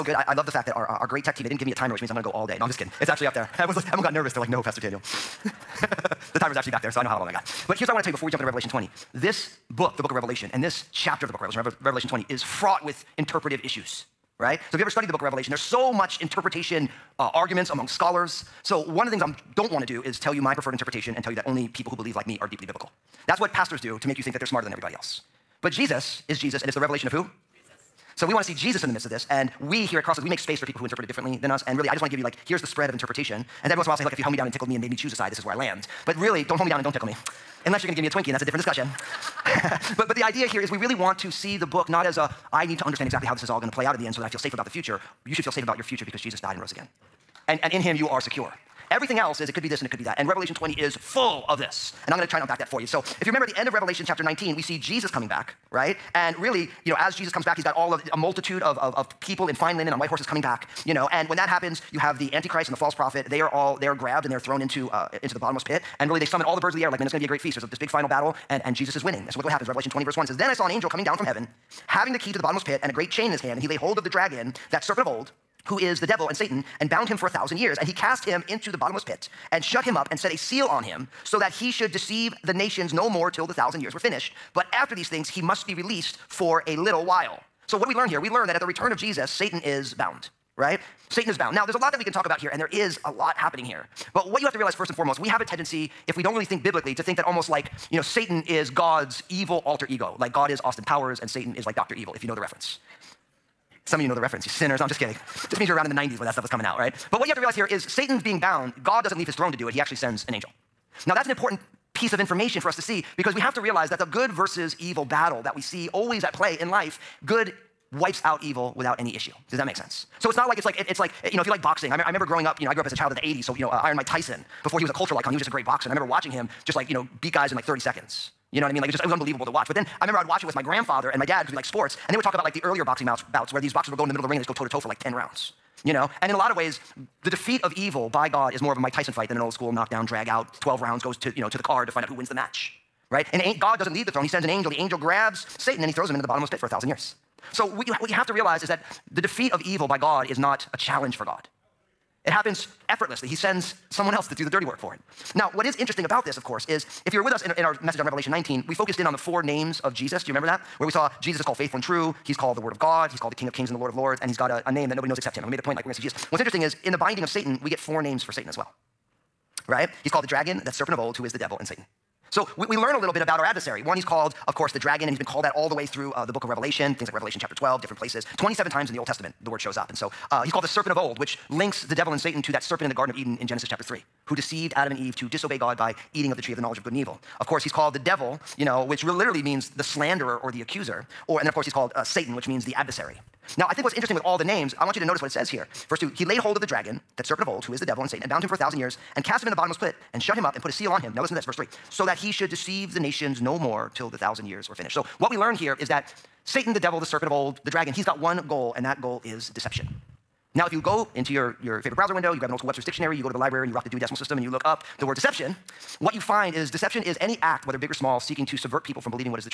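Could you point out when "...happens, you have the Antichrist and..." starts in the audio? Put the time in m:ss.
1:01.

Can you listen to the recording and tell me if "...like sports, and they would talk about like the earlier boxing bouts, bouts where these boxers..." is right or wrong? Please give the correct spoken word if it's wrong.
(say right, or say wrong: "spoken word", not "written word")
right.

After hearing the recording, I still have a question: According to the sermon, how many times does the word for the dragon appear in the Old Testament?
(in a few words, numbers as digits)
27.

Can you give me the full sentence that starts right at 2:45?
And we made the point like, we're gonna see Jesus.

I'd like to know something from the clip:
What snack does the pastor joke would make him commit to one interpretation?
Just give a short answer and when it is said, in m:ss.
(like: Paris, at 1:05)
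Twinkie, at 0:38.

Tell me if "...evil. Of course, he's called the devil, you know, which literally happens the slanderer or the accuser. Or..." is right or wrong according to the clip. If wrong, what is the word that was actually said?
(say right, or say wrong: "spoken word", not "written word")
wrong: "means", not "happens".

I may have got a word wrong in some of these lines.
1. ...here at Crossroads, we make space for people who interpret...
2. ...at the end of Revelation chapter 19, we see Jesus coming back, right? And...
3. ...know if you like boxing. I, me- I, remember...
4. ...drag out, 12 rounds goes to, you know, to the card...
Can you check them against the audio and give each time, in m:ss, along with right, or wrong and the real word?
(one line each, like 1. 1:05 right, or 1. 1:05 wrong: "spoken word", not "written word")
1. 0:29 right
2. 0:53 right
3. 2:01 right
4. 2:20 right.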